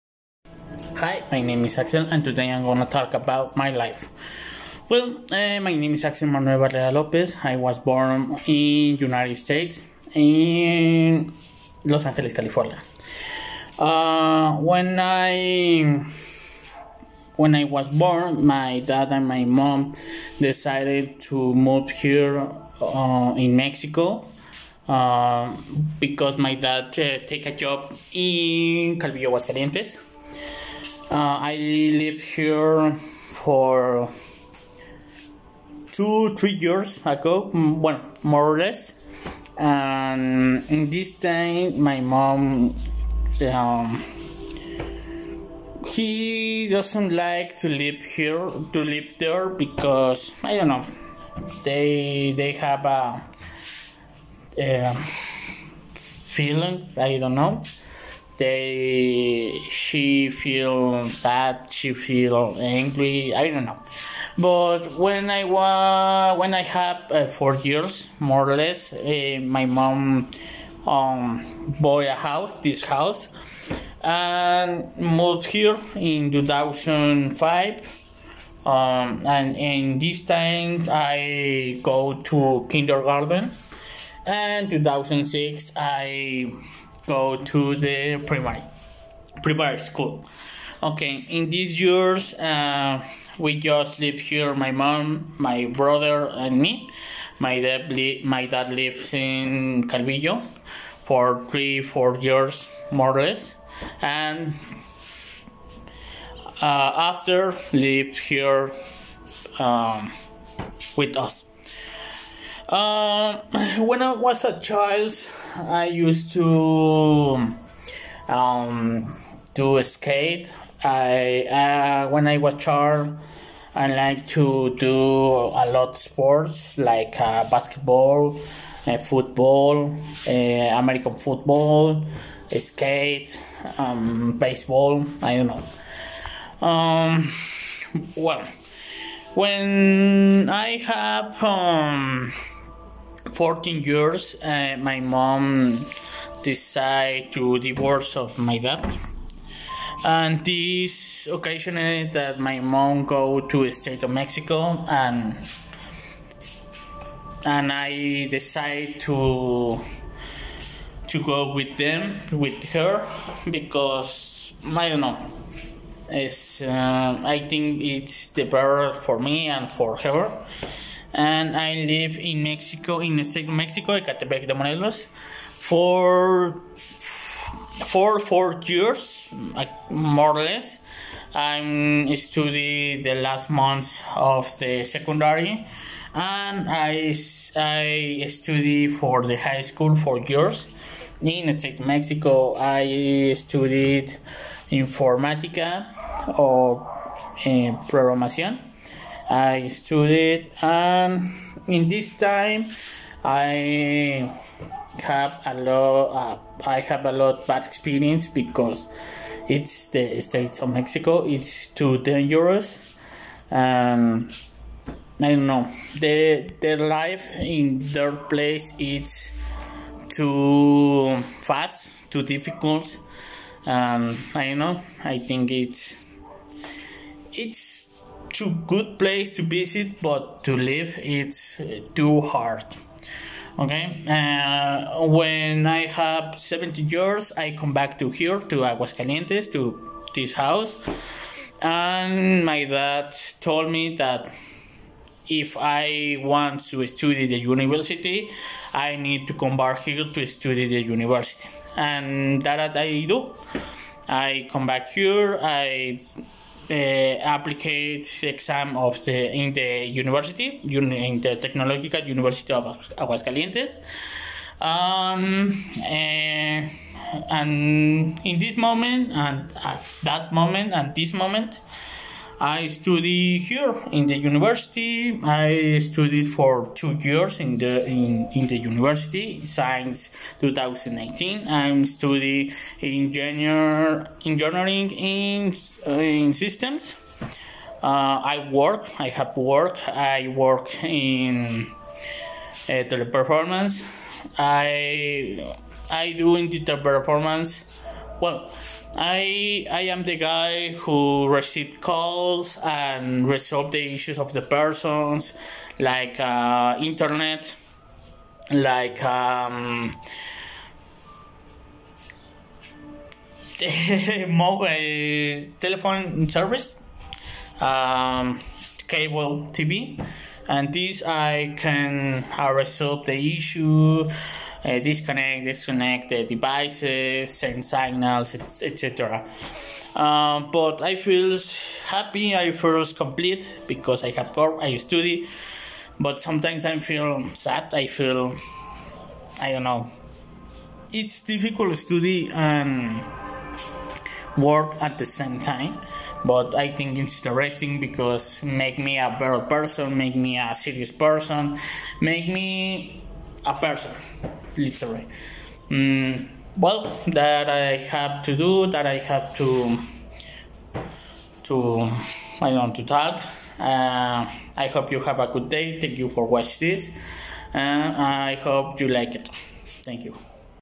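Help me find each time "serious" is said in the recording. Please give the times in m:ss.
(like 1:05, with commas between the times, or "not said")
5:50.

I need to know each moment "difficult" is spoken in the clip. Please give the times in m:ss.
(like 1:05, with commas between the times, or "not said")
3:42, 5:41.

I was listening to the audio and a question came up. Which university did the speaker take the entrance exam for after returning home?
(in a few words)
Technological University of Aguascalientes.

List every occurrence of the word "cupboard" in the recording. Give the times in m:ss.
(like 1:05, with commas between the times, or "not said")
not said.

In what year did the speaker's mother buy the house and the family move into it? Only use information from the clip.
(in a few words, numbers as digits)
2005.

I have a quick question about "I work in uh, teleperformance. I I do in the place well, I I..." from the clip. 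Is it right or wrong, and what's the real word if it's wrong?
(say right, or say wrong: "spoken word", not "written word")
wrong: "teleperformance", not "place".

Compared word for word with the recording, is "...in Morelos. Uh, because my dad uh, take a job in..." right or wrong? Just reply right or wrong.
wrong.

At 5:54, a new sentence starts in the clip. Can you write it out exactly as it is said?
Literally, Mm, well, that I have to do, that I have to to I don't to talk.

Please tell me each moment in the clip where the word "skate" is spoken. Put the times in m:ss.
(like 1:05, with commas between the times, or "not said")
1:59, 2:12.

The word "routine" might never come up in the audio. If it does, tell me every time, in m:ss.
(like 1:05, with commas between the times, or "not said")
not said.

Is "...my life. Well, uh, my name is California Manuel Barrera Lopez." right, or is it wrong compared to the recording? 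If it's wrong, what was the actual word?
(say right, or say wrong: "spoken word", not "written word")
wrong: "Axel", not "California".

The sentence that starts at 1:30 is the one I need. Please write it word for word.
Okay, in these years, uh, we just live here.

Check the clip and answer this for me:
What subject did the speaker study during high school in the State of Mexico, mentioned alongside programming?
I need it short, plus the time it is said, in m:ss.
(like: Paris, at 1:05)
Informatica, at 3:14.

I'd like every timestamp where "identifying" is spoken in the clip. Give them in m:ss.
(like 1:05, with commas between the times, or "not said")
not said.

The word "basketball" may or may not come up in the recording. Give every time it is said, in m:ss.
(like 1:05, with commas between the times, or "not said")
2:07.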